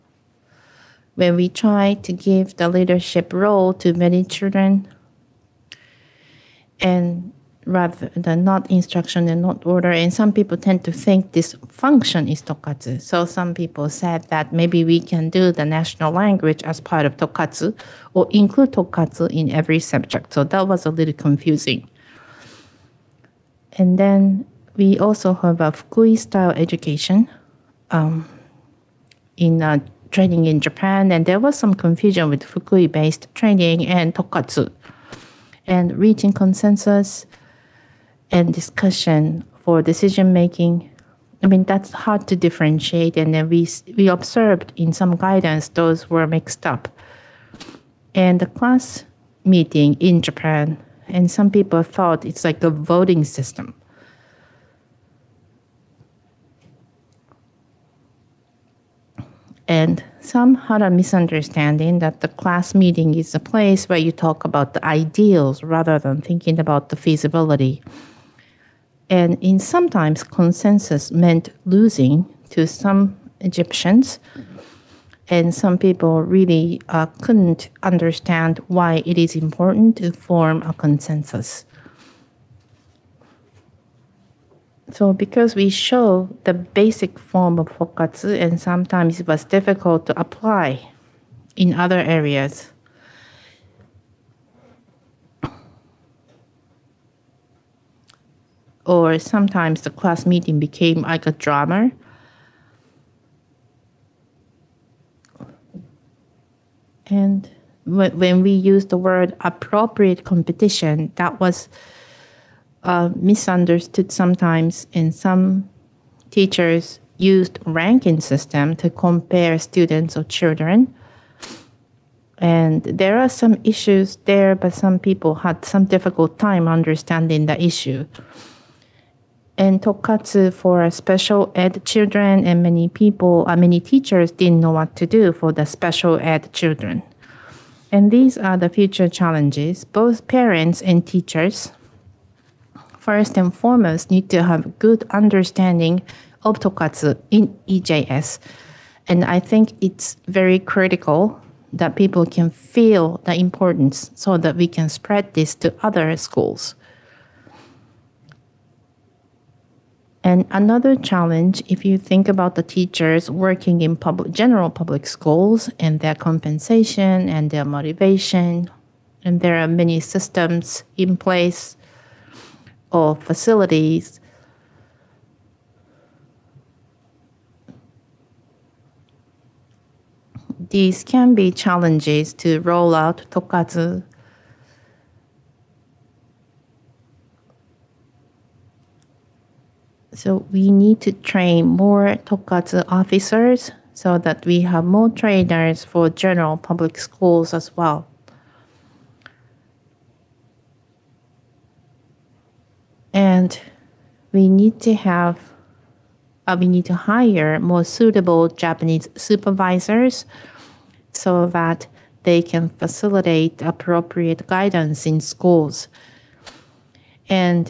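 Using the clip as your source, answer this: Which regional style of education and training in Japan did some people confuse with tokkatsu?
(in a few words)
Fukui style.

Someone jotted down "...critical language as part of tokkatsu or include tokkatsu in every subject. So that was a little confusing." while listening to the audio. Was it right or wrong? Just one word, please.
wrong.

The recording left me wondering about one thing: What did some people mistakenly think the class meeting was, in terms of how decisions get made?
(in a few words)
a voting system.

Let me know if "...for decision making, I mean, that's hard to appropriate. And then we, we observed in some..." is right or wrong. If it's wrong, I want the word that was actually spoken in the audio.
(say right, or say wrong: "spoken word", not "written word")
wrong: "differentiate", not "appropriate".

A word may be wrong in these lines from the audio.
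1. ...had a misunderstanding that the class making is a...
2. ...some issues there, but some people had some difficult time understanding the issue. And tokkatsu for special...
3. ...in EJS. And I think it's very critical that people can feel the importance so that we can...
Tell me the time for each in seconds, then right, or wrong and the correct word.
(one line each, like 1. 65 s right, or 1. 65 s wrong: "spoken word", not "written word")
1. 60 s wrong: "meeting", not "making"
2. 123 s right
3. 147 s right.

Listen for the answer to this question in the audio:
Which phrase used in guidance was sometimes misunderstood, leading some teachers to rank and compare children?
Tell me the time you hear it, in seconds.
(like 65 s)
109 s.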